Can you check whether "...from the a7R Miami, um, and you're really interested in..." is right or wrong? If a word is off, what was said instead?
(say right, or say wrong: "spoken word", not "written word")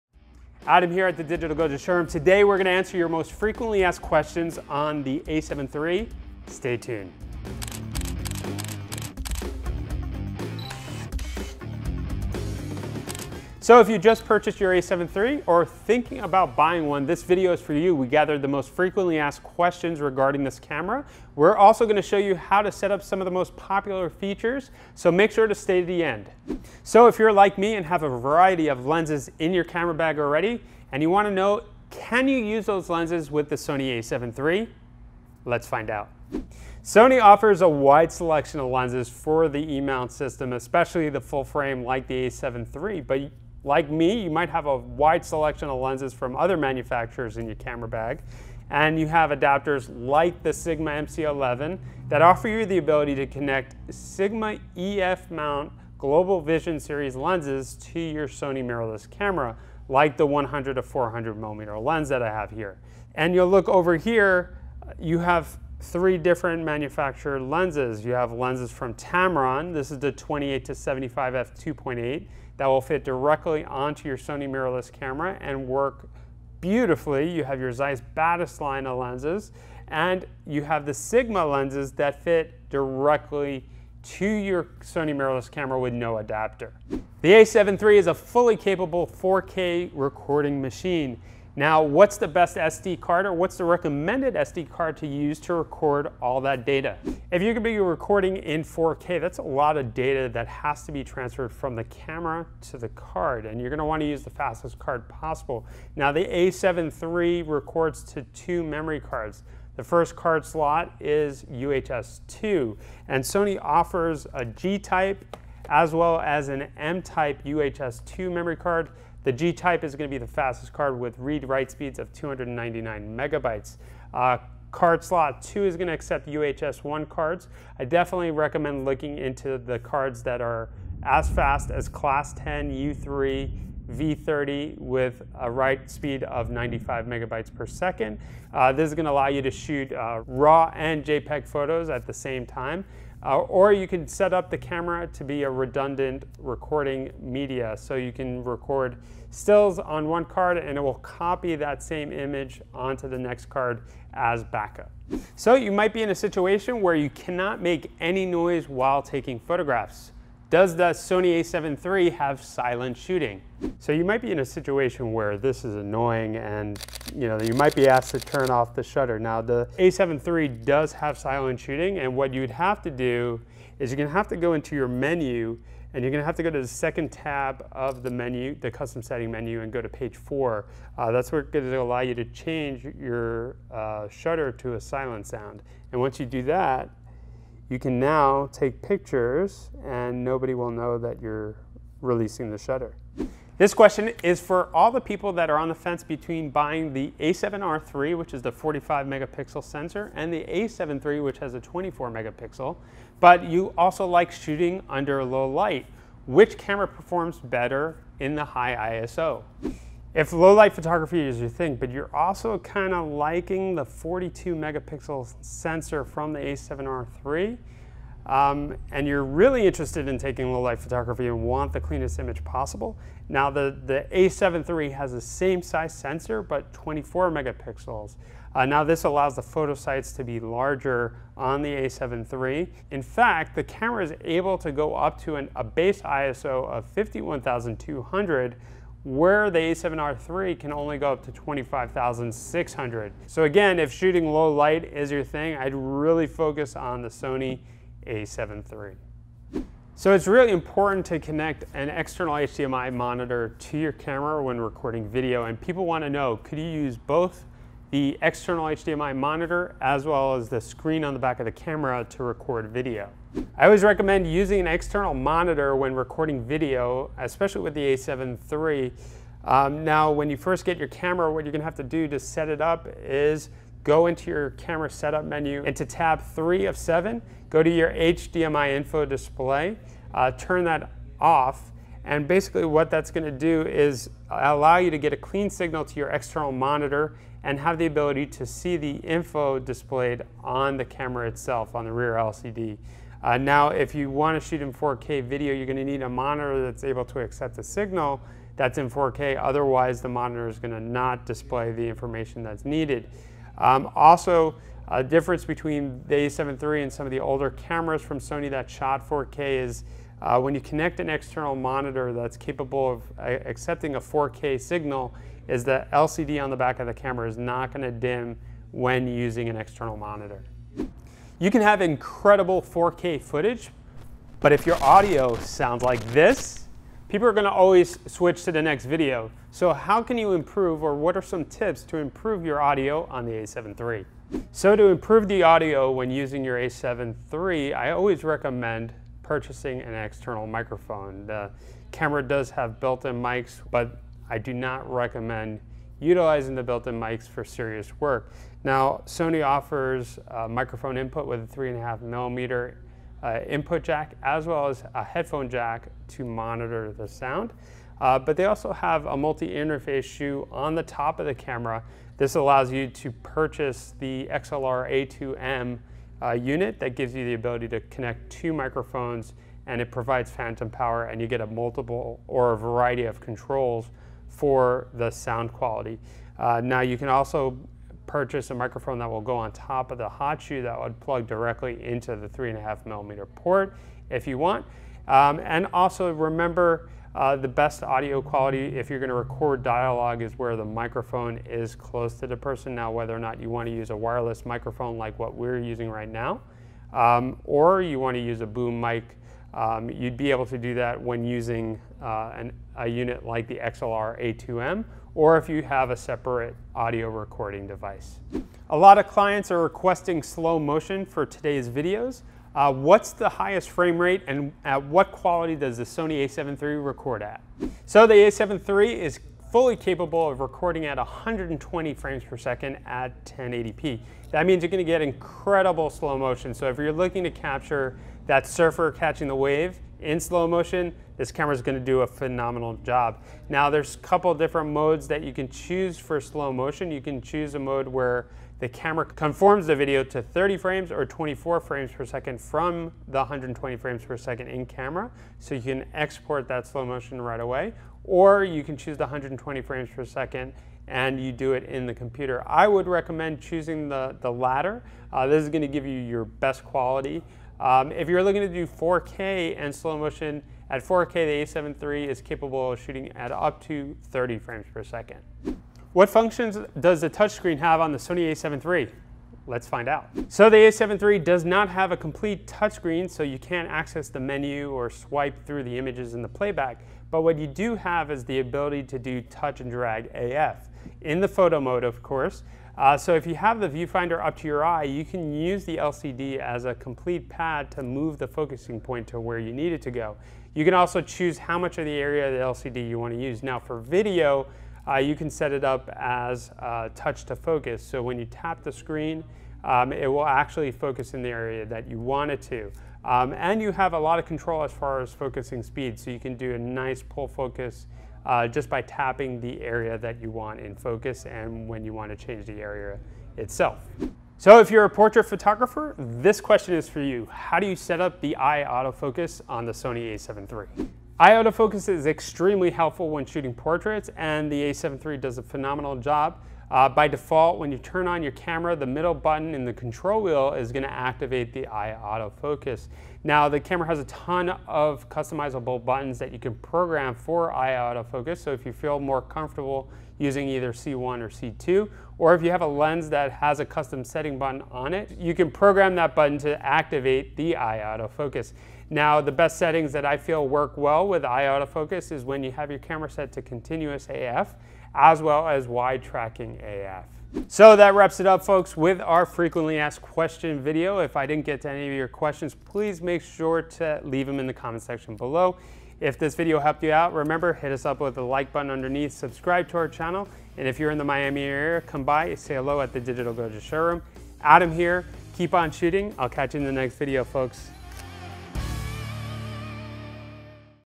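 wrong: "III", not "Miami".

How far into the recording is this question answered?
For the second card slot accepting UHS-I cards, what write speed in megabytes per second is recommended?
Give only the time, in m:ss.
2:16.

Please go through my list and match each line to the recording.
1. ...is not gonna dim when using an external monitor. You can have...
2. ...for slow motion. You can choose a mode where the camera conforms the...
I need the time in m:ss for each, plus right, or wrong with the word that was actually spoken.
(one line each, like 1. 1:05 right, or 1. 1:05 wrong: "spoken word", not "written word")
1. 5:17 right
2. 7:15 right.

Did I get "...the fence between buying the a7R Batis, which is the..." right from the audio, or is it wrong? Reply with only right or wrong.
wrong.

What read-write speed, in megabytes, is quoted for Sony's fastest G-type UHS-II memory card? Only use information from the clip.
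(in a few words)
299 megabytes.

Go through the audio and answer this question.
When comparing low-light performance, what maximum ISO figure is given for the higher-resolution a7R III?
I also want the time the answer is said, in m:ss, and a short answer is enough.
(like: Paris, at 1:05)
25,600, at 4:01.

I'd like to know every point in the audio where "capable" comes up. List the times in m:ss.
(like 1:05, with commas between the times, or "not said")
1:28, 5:12, 6:59, 7:42.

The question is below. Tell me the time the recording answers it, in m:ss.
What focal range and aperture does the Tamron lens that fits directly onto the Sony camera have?
1:10.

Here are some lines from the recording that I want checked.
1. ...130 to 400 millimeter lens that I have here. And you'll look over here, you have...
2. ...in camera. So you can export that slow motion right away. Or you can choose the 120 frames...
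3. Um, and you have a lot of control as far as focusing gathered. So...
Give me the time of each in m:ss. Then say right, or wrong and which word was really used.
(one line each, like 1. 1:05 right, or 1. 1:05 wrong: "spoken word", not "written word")
1. 1:00 wrong: "100", not "130"
2. 7:24 right
3. 8:23 wrong: "speed", not "gathered".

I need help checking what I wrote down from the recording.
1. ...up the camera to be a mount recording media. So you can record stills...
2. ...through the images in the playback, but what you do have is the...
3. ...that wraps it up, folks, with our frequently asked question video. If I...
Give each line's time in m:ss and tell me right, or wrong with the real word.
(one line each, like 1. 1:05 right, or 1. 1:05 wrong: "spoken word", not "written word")
1. 2:24 wrong: "redundant", not "mount"
2. 7:55 right
3. 9:17 right.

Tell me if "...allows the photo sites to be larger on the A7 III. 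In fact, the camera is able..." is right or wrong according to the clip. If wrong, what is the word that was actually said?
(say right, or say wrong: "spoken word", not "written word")
right.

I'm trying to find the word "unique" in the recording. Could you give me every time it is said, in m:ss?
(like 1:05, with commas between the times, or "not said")
not said.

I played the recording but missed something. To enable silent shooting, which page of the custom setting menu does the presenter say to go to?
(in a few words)
page four.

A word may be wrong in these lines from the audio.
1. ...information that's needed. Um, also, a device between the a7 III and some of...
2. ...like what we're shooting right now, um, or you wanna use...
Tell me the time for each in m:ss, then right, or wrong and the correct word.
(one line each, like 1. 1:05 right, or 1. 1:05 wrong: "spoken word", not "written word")
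1. 5:01 wrong: "difference", not "device"
2. 6:34 wrong: "using", not "shooting".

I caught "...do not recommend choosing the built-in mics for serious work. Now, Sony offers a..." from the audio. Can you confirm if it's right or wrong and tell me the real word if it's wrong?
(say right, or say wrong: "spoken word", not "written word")
wrong: "utilizing", not "choosing".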